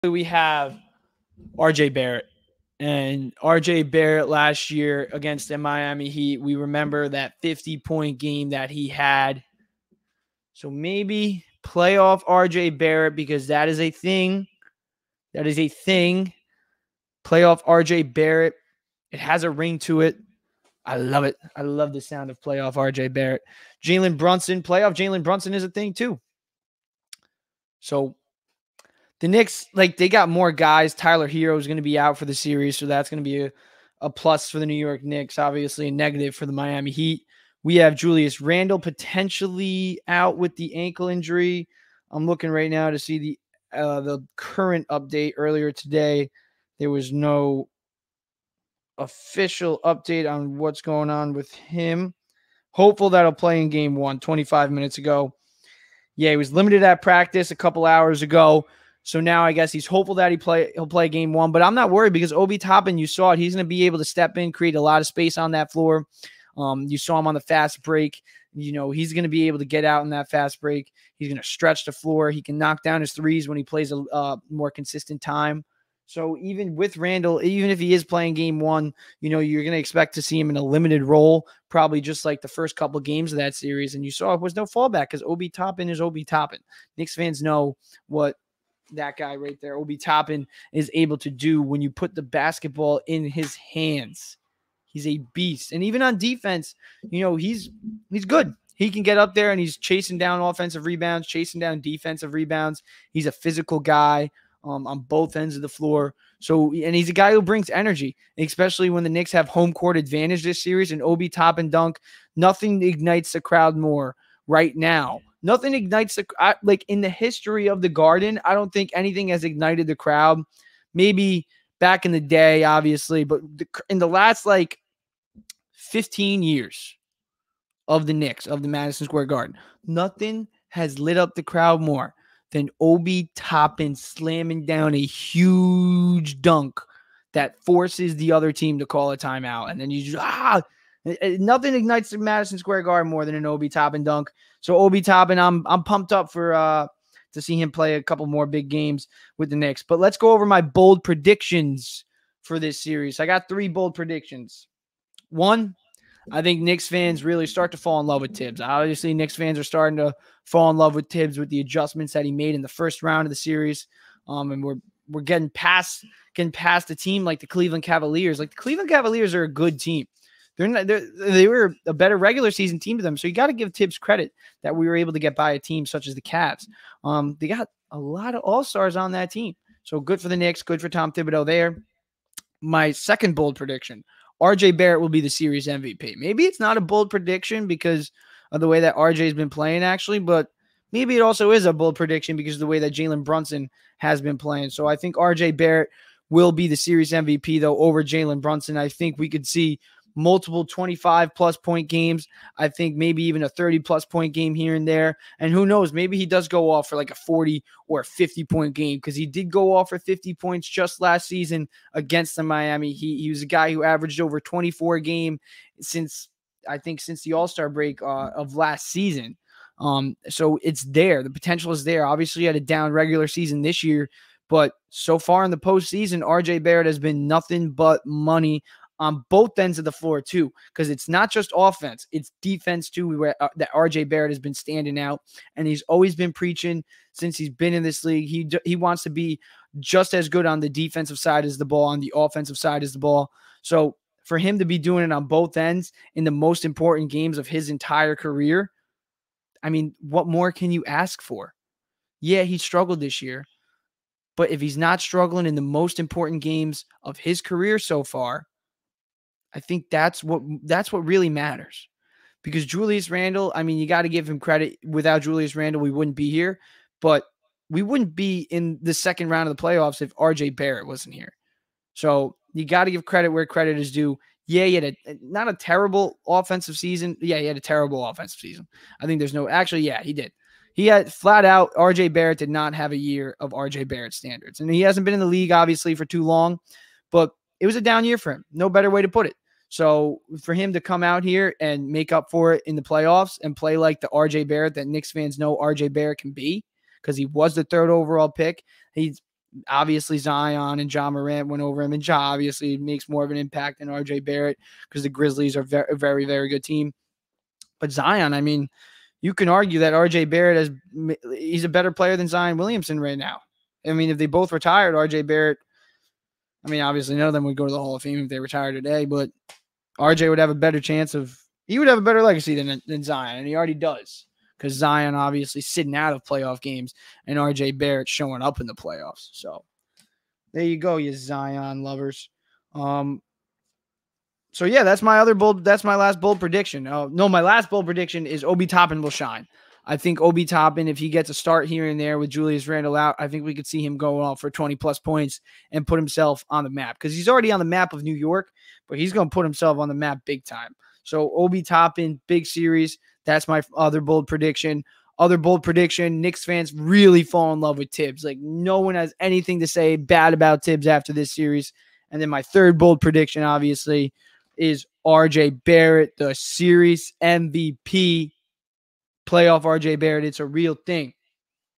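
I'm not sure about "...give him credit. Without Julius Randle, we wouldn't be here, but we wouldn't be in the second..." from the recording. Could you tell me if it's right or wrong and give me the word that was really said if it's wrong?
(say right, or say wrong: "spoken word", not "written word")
right.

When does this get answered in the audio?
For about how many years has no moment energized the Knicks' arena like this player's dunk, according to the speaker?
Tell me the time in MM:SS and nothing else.
02:05.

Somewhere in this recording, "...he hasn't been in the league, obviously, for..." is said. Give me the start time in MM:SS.
04:44.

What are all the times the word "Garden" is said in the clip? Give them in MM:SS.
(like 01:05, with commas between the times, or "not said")
01:57, 02:09, 02:22.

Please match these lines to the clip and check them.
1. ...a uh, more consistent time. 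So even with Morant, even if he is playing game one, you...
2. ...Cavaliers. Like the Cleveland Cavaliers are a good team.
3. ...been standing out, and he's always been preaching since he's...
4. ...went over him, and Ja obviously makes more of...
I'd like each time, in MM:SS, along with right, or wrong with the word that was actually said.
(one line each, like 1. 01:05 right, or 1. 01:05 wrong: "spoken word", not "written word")
1. 01:13 wrong: "Randle", not "Morant"
2. 02:47 right
3. 03:54 right
4. 05:01 right.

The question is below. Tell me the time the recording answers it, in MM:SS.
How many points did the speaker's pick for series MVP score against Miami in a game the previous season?
03:29.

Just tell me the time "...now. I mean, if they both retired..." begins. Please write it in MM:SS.
05:13.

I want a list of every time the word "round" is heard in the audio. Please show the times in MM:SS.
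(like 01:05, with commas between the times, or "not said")
02:43, 04:29.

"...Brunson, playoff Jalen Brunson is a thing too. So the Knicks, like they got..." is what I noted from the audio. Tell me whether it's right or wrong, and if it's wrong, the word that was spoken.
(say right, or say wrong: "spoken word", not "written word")
right.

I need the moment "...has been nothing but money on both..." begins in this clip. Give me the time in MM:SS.
03:46.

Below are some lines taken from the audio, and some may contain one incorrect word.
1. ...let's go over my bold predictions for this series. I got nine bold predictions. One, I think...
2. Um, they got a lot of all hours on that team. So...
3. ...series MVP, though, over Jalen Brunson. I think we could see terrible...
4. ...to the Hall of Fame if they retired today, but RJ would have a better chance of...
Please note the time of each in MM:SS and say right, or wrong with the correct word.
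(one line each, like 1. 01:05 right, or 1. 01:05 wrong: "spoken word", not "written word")
1. 02:29 wrong: "three", not "nine"
2. 02:57 wrong: "stars", not "hours"
3. 03:16 wrong: "multiple", not "terrible"
4. 05:17 right.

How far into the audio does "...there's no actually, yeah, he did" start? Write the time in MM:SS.
04:39.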